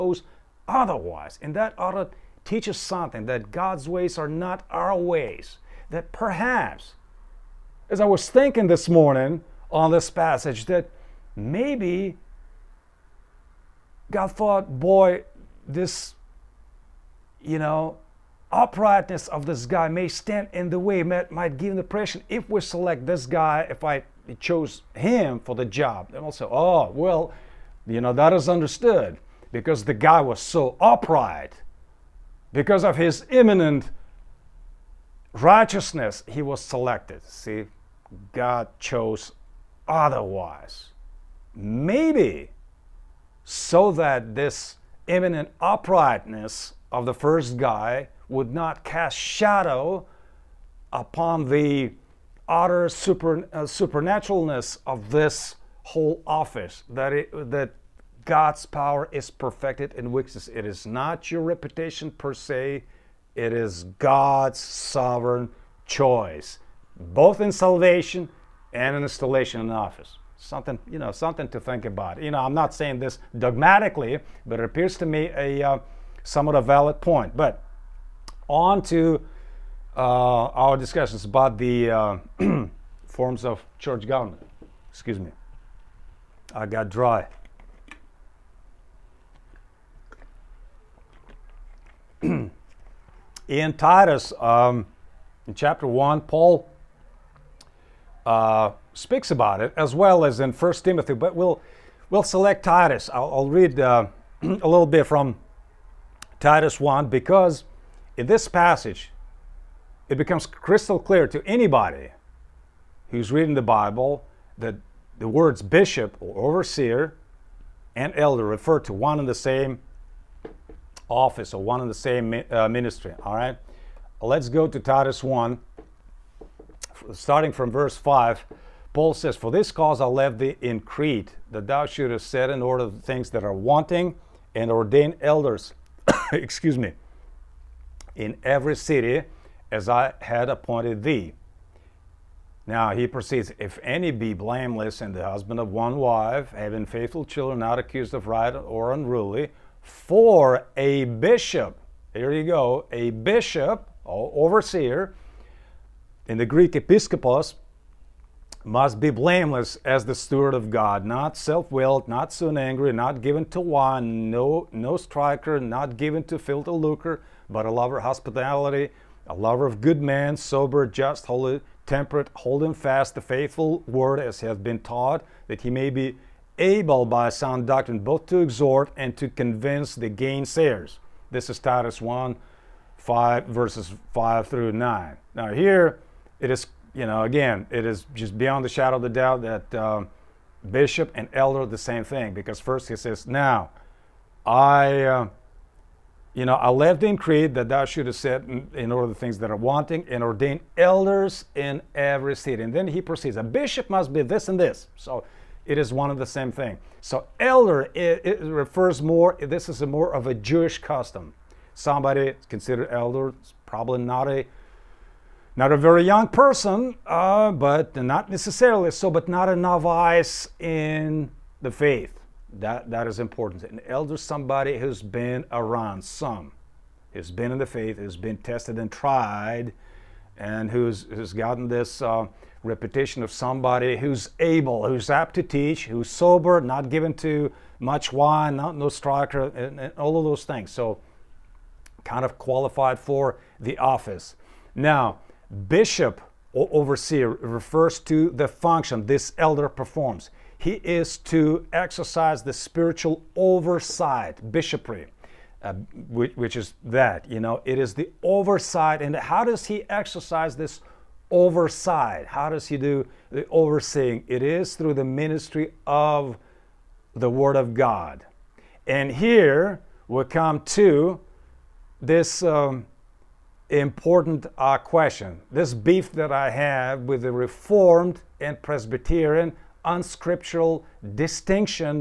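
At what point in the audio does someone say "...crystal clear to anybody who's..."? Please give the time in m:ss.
1:50.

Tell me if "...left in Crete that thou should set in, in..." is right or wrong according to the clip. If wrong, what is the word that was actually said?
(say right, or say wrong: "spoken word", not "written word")
right.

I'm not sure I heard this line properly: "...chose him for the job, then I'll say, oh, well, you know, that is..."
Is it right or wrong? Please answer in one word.
right.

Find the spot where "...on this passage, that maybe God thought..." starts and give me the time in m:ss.
0:09.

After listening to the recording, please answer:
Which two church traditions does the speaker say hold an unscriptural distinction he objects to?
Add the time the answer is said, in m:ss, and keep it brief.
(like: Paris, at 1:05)
Reformed and Presbyterian, at 4:37.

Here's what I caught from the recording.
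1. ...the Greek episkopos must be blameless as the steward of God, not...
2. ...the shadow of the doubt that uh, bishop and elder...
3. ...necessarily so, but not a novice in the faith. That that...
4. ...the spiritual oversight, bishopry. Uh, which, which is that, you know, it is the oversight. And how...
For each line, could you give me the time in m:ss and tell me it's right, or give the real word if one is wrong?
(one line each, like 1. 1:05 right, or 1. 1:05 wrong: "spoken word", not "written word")
1. 2:36 right
2. 3:08 right
3. 3:38 right
4. 4:12 right.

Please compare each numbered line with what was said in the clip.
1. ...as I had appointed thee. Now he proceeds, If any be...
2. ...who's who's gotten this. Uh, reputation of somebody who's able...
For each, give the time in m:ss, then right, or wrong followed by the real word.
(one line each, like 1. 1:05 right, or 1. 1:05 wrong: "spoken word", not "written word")
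1. 2:19 right
2. 3:50 right.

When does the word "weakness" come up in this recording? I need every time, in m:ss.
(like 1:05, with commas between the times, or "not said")
1:00.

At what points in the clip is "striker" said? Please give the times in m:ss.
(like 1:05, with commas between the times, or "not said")
2:44, 3:58.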